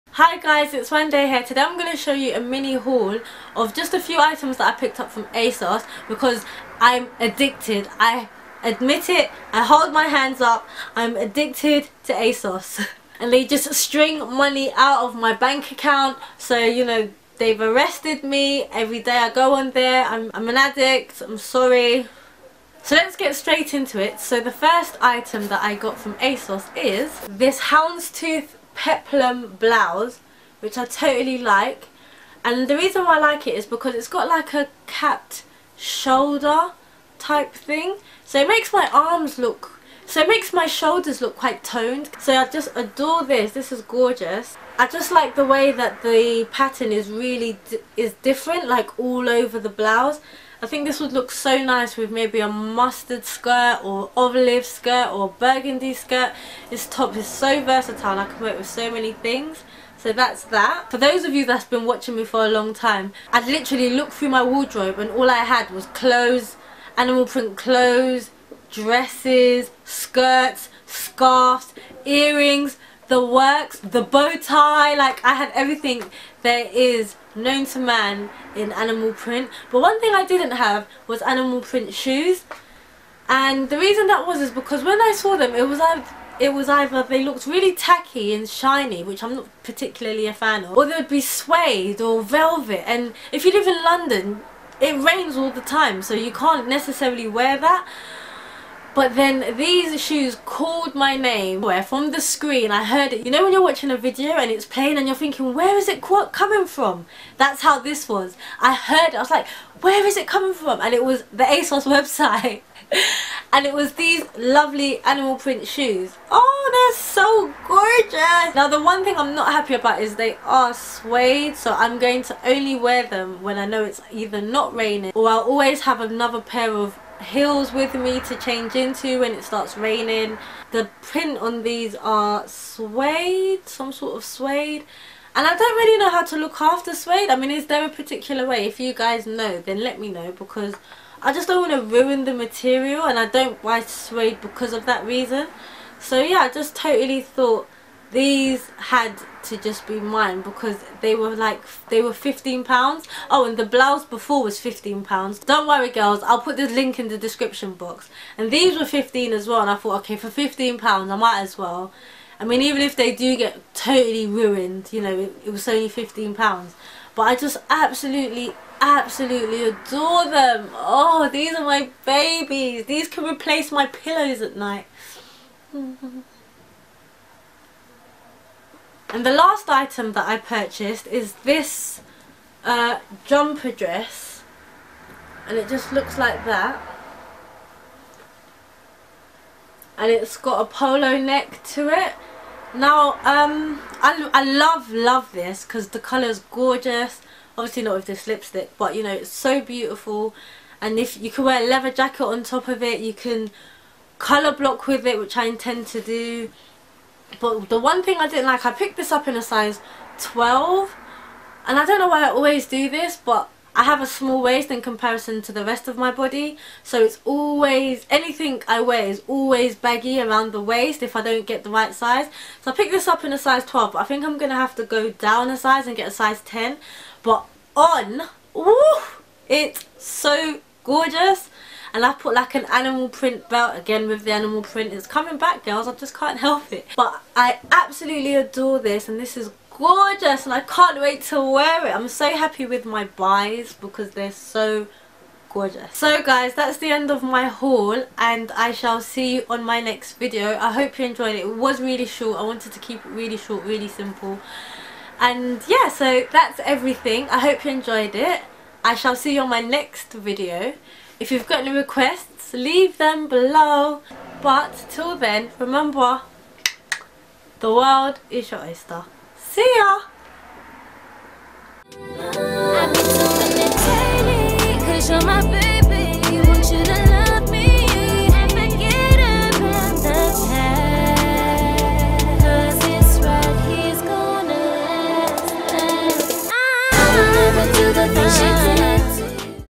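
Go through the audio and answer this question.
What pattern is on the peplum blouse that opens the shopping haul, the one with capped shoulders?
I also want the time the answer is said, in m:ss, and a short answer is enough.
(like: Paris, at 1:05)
Houndstooth, at 0:27.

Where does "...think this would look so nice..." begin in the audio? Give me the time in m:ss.
0:50.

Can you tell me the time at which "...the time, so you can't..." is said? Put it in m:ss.
1:35.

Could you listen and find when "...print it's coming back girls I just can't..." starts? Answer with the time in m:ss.
3:54.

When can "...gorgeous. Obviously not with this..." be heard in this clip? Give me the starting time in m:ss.
3:16.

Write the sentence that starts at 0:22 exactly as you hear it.
So let's get straight into it.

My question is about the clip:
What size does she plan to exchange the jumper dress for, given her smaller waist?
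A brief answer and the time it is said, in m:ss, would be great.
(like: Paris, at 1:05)
10, at 3:46.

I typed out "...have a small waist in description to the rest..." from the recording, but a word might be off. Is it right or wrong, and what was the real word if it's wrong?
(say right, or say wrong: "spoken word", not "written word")
wrong: "comparison", not "description".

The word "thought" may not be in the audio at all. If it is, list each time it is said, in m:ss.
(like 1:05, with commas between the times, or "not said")
2:27, 2:39.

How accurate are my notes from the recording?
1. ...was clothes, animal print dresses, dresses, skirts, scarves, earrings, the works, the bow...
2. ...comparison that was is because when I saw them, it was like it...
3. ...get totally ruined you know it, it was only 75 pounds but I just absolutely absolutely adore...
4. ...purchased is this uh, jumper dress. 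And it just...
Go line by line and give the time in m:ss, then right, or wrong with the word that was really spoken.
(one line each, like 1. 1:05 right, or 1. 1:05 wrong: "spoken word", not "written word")
1. 1:05 wrong: "clothes", not "dresses"
2. 1:23 wrong: "reason", not "comparison"
3. 2:43 wrong: "15", not "75"
4. 3:00 right.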